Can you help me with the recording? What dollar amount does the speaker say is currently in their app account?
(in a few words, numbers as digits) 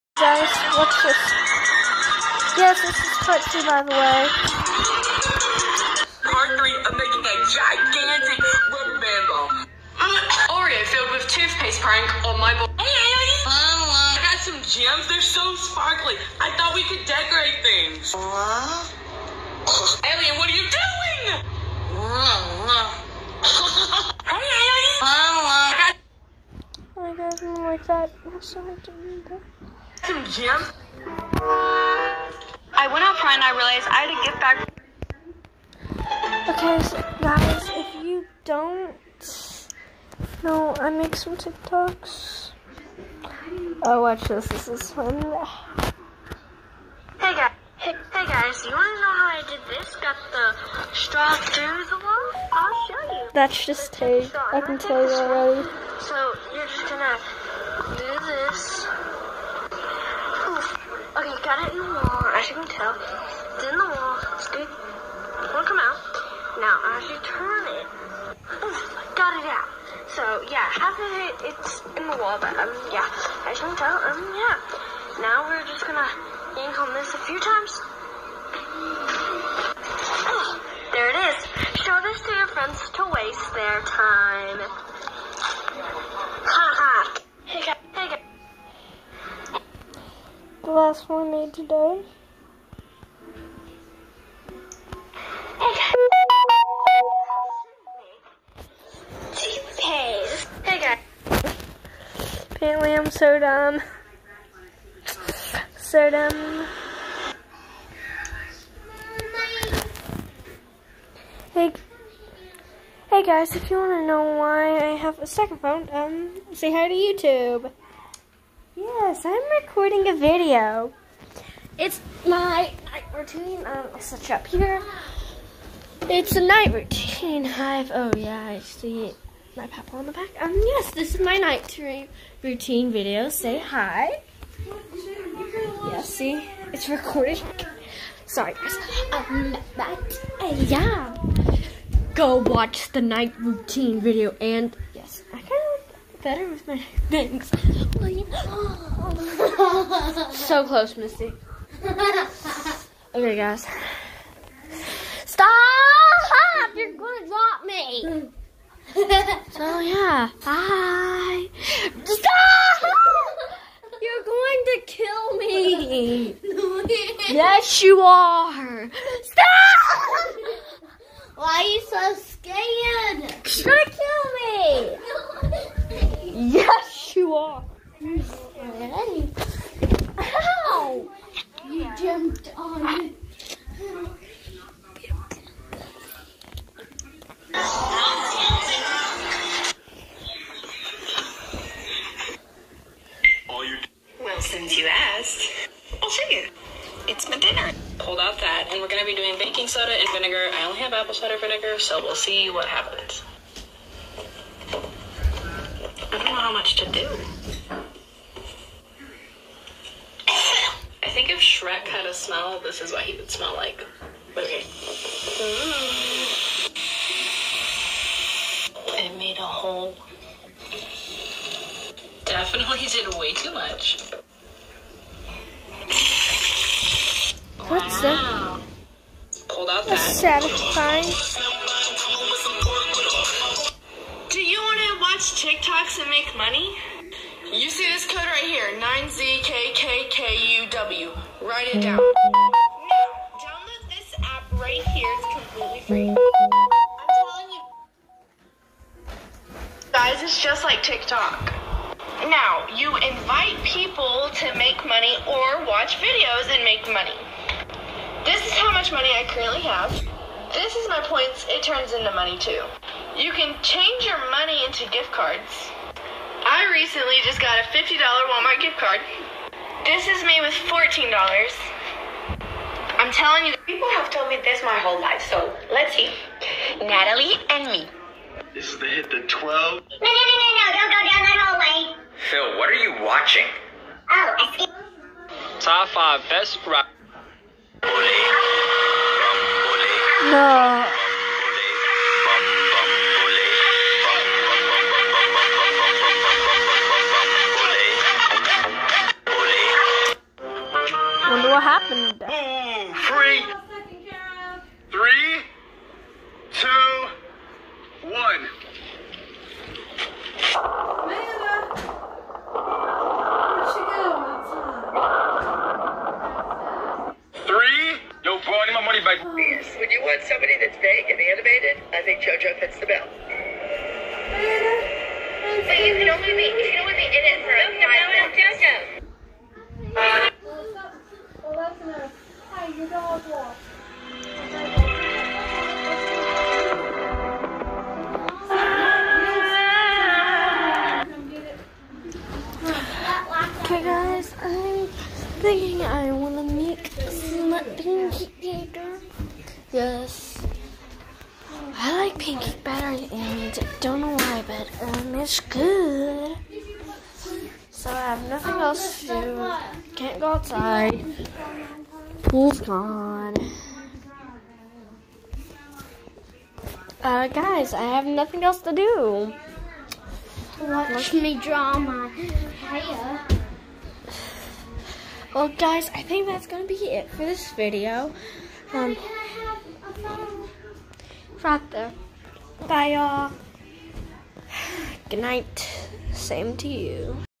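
$14.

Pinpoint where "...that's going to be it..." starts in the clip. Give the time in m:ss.
6:16.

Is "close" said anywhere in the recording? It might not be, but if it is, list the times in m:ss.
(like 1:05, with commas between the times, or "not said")
2:30.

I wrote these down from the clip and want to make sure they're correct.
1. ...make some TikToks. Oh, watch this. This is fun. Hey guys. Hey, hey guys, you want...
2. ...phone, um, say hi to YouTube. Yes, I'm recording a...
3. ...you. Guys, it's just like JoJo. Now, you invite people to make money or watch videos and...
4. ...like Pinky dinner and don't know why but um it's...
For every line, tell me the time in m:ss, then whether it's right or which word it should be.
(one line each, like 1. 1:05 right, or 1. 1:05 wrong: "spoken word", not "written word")
1. 0:40 right
2. 1:55 right
3. 4:07 wrong: "TikTok", not "JoJo"
4. 5:52 wrong: "better", not "dinner".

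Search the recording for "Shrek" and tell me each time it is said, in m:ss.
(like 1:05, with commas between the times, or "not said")
3:31.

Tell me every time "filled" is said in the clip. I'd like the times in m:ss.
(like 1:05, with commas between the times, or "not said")
0:10.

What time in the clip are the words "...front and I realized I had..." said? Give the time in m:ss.
0:33.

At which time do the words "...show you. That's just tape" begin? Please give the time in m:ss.
0:52.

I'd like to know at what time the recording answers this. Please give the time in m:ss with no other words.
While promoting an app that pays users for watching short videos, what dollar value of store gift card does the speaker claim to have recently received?
4:27.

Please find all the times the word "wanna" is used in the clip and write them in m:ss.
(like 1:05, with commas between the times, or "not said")
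5:46.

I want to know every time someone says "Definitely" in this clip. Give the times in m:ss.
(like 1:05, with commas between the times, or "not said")
3:42.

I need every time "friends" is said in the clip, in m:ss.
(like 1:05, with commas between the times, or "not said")
1:22.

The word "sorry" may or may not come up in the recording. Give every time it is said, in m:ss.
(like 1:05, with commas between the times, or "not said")
0:28, 2:18.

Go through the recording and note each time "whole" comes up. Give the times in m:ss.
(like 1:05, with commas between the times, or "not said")
4:34.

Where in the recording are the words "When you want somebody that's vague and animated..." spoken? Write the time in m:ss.
5:19.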